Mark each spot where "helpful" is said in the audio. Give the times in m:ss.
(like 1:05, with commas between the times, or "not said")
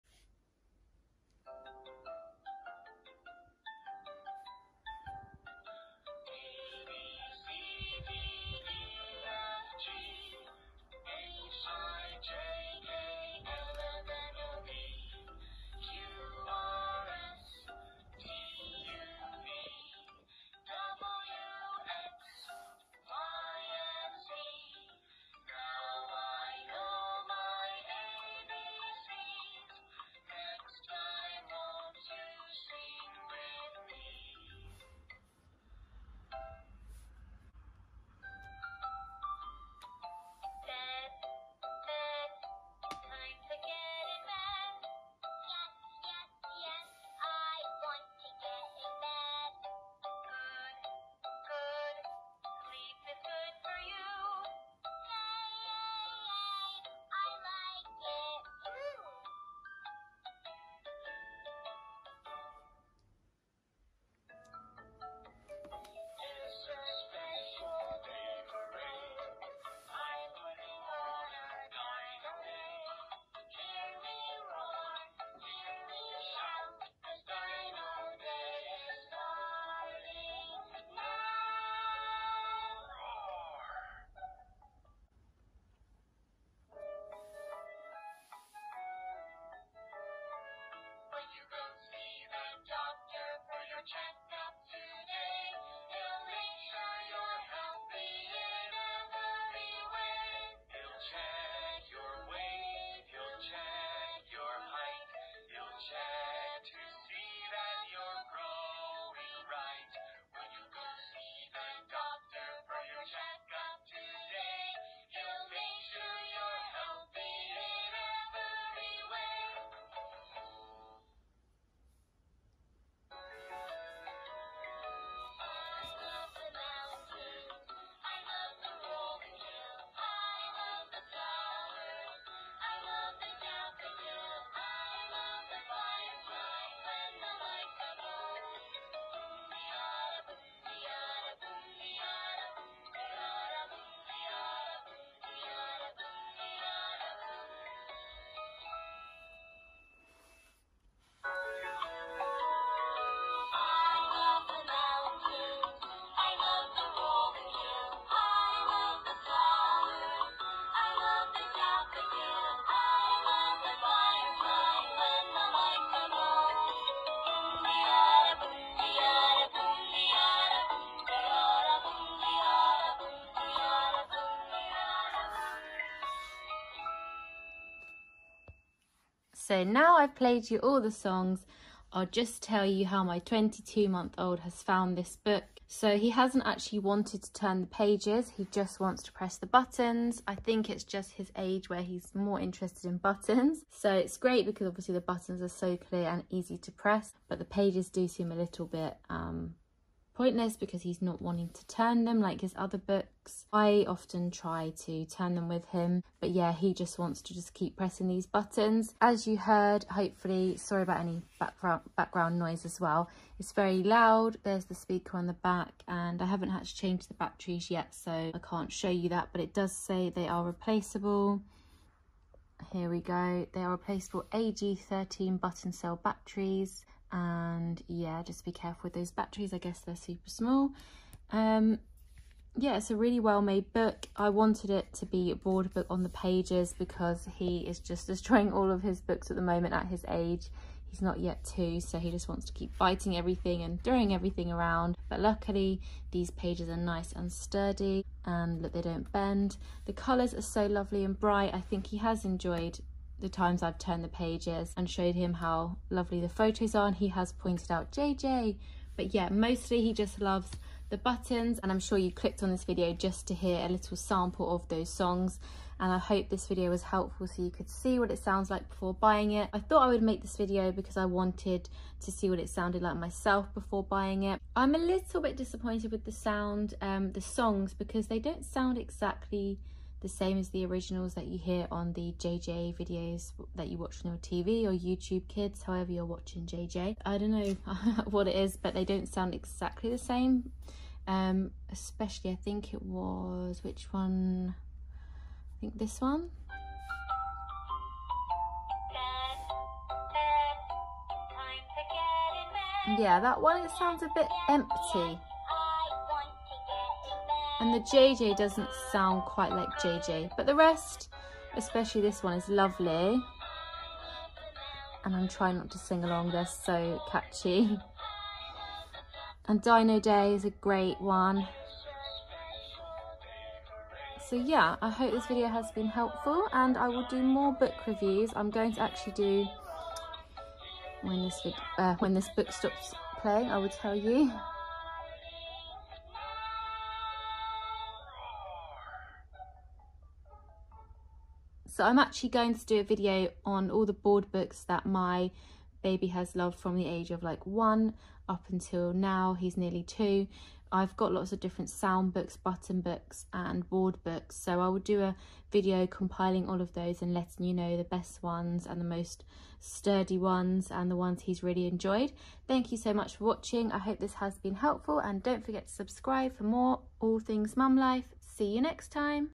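4:26, 5:25, 6:04.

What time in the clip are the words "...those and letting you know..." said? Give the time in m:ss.
5:56.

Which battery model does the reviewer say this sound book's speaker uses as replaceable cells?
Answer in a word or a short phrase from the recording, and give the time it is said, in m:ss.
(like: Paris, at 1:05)
AG13, at 3:44.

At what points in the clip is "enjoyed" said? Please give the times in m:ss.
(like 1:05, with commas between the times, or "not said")
4:12, 6:01.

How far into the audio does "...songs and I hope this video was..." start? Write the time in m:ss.
4:24.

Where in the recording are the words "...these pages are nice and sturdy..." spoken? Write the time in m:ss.
4:06.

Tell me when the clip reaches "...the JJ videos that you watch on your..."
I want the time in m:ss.
4:41.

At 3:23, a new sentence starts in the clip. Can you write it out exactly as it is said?
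I often try to turn them with him, but yeah, he just wants to just keep pressing these buttons.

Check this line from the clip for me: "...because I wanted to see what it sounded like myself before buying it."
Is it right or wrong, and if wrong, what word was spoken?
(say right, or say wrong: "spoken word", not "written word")
right.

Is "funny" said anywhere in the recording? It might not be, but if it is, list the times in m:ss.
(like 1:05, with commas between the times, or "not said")
not said.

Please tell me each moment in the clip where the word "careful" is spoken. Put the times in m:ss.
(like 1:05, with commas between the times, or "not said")
3:48.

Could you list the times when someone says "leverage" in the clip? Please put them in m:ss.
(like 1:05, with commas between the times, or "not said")
not said.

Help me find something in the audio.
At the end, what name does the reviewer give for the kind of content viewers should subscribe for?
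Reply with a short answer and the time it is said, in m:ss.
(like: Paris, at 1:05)
All Things Mum Life, at 6:06.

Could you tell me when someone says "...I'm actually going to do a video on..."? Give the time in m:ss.
5:41.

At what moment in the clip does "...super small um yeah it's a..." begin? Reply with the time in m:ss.
3:49.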